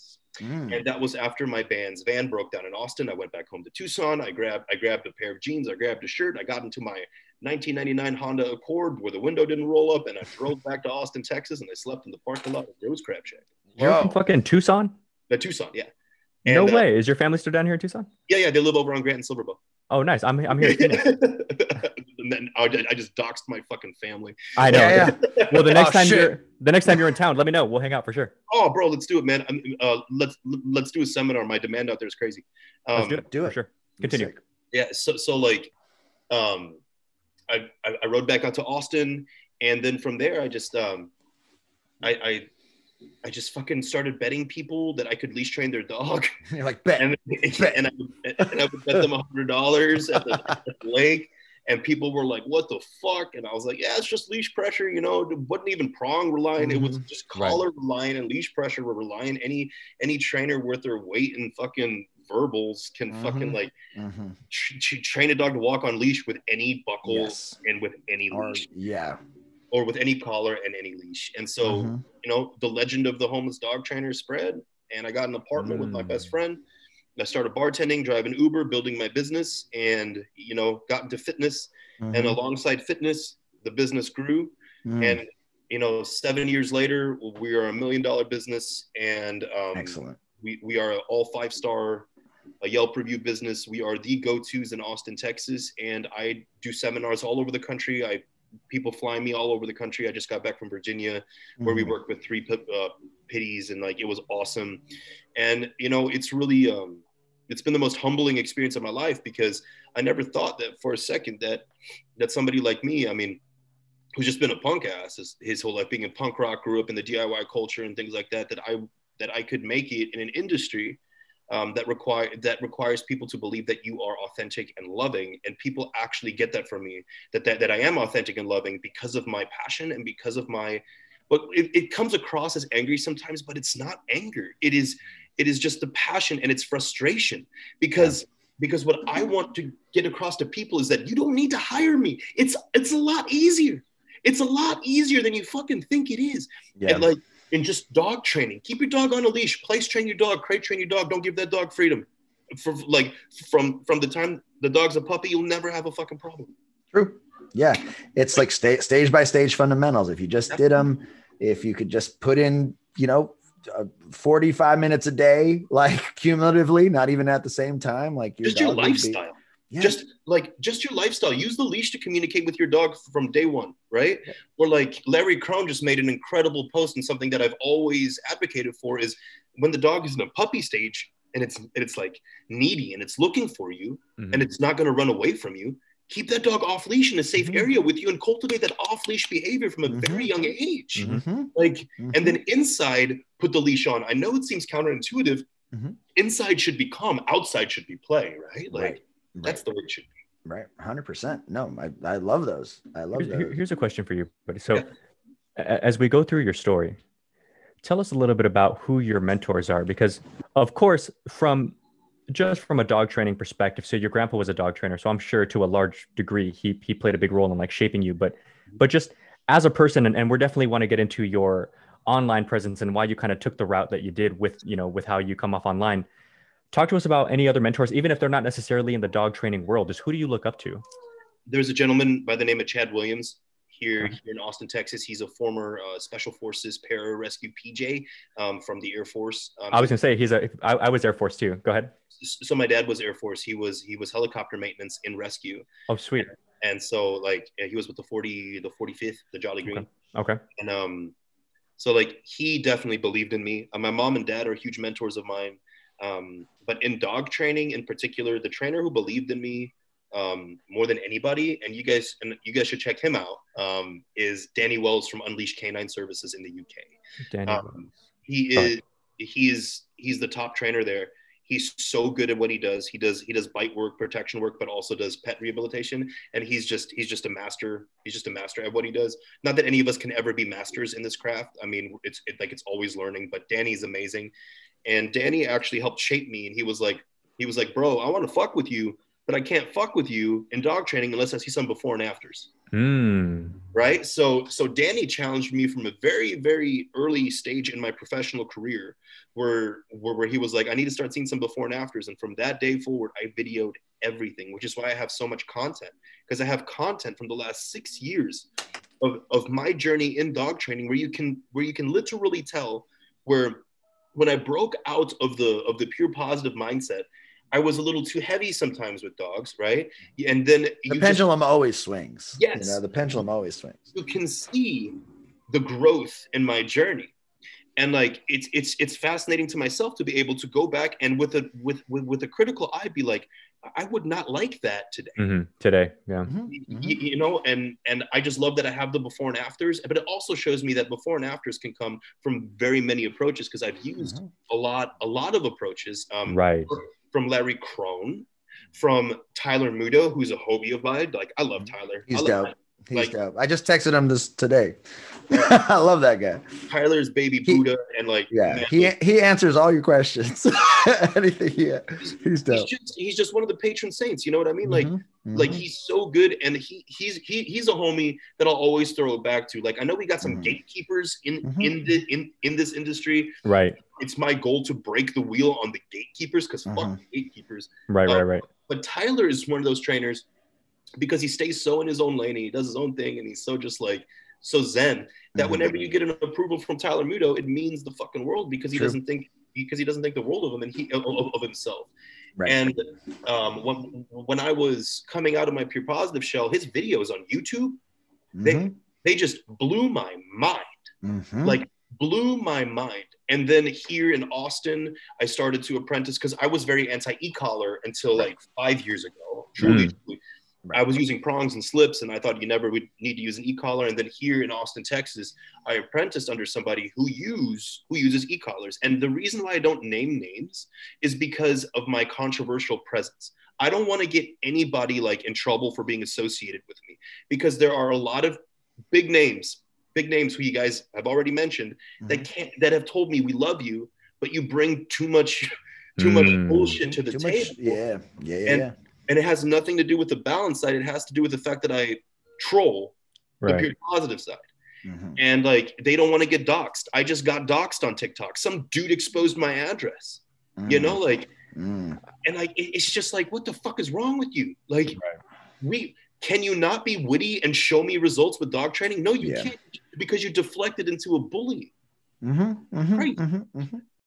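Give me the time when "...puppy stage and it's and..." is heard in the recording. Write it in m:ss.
3:00.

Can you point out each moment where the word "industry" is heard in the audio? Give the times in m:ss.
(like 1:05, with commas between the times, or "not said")
2:00, 6:12.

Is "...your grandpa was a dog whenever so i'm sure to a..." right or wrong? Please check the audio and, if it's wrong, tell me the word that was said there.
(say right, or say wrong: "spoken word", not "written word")
wrong: "trainer", not "whenever".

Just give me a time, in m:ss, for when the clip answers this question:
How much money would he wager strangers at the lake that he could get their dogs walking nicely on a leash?
0:49.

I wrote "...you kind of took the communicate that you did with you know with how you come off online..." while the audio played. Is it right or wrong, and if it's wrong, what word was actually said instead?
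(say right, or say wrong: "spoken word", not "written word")
wrong: "route", not "communicate".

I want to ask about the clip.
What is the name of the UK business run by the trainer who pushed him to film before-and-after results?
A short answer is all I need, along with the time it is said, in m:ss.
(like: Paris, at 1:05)
Unleashed Canine Services, at 4:25.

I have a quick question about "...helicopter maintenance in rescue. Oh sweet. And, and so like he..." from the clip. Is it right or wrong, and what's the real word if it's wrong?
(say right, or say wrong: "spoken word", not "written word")
right.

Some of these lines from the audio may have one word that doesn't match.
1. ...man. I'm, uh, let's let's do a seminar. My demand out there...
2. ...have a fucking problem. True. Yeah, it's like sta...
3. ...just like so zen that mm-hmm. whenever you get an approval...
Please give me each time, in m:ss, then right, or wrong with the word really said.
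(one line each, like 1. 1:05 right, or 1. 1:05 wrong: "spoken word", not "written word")
1. 0:29 right
2. 2:35 right
3. 6:23 right.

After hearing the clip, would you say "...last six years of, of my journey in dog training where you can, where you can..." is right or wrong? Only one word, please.
right.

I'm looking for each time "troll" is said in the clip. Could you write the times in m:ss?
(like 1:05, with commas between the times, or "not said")
7:22.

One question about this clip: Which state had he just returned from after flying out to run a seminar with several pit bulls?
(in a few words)
Virginia.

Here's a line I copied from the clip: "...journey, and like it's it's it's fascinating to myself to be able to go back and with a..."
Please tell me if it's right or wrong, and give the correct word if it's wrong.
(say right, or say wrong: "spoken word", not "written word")
right.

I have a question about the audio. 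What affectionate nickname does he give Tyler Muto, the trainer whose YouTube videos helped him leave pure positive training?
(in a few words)
Baby Buddha.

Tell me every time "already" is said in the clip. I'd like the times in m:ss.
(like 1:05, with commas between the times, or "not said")
7:11.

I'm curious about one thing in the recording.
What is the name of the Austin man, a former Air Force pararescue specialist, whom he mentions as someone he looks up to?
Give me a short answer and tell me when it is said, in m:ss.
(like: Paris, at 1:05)
Chad Williams, at 3:52.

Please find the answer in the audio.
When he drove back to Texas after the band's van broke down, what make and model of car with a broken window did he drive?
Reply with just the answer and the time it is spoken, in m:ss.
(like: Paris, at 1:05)
Honda Accord, at 0:08.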